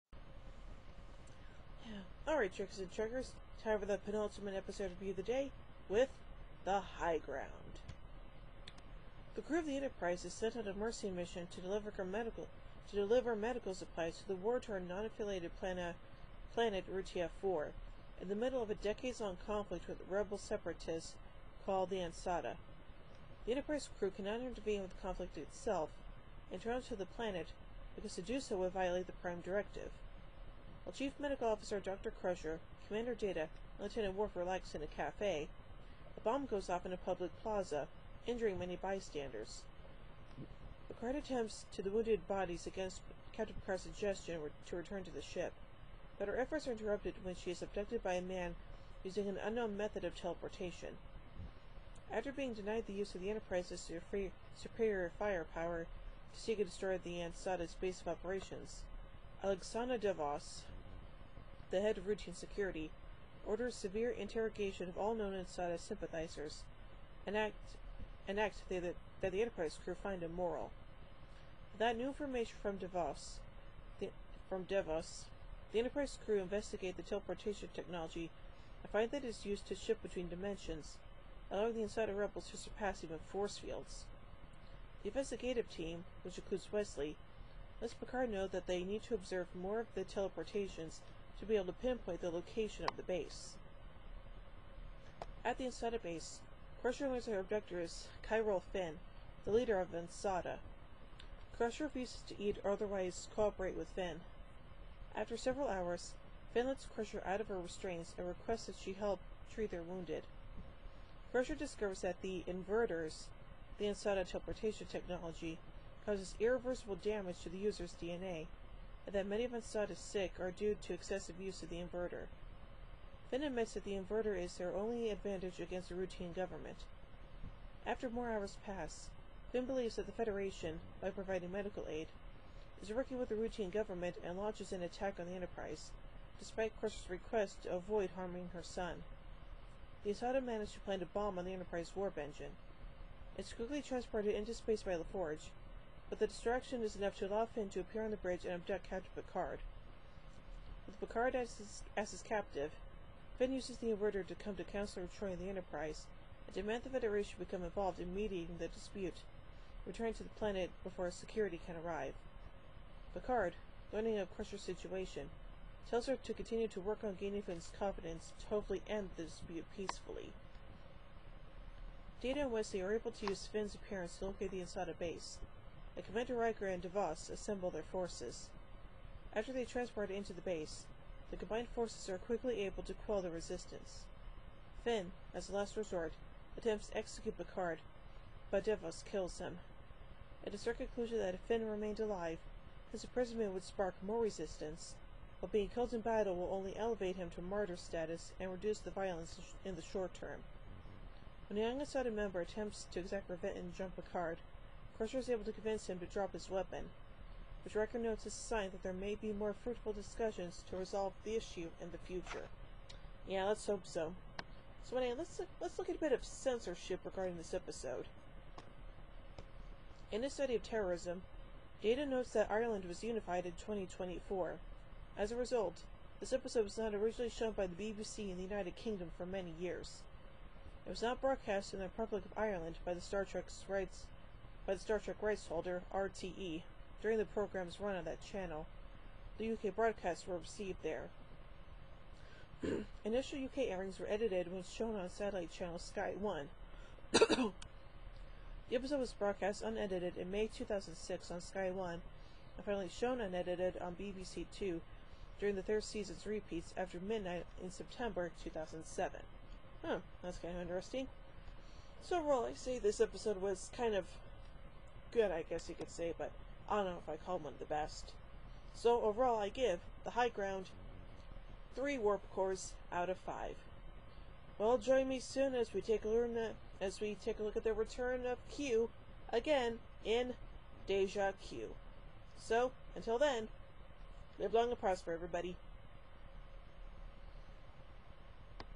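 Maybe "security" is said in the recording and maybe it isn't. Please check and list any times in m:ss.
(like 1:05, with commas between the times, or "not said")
1:02, 2:41.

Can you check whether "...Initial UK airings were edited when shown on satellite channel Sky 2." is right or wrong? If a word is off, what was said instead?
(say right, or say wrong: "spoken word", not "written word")
wrong: "1", not "2".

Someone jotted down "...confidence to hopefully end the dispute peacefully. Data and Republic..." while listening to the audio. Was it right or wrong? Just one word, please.
wrong.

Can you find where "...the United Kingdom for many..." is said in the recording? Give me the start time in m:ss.
3:48.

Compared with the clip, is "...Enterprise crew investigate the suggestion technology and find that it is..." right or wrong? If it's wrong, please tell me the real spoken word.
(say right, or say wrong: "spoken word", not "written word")
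wrong: "teleportation", not "suggestion".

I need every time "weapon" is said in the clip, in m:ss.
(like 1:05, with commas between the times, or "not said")
3:26.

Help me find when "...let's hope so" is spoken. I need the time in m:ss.
3:33.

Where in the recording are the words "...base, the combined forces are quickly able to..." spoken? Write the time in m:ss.
3:00.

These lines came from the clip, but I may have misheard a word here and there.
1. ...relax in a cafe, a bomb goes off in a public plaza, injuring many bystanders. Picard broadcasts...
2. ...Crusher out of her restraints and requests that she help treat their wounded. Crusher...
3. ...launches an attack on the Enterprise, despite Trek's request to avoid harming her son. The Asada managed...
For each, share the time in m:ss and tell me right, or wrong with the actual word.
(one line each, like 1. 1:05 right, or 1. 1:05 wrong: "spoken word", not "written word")
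1. 0:34 wrong: "attempts", not "broadcasts"
2. 1:46 right
3. 2:14 wrong: "Crusher", not "Trek".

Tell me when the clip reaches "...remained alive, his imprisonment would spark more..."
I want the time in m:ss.
3:11.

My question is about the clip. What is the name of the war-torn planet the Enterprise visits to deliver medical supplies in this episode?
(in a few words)
Rutia-4.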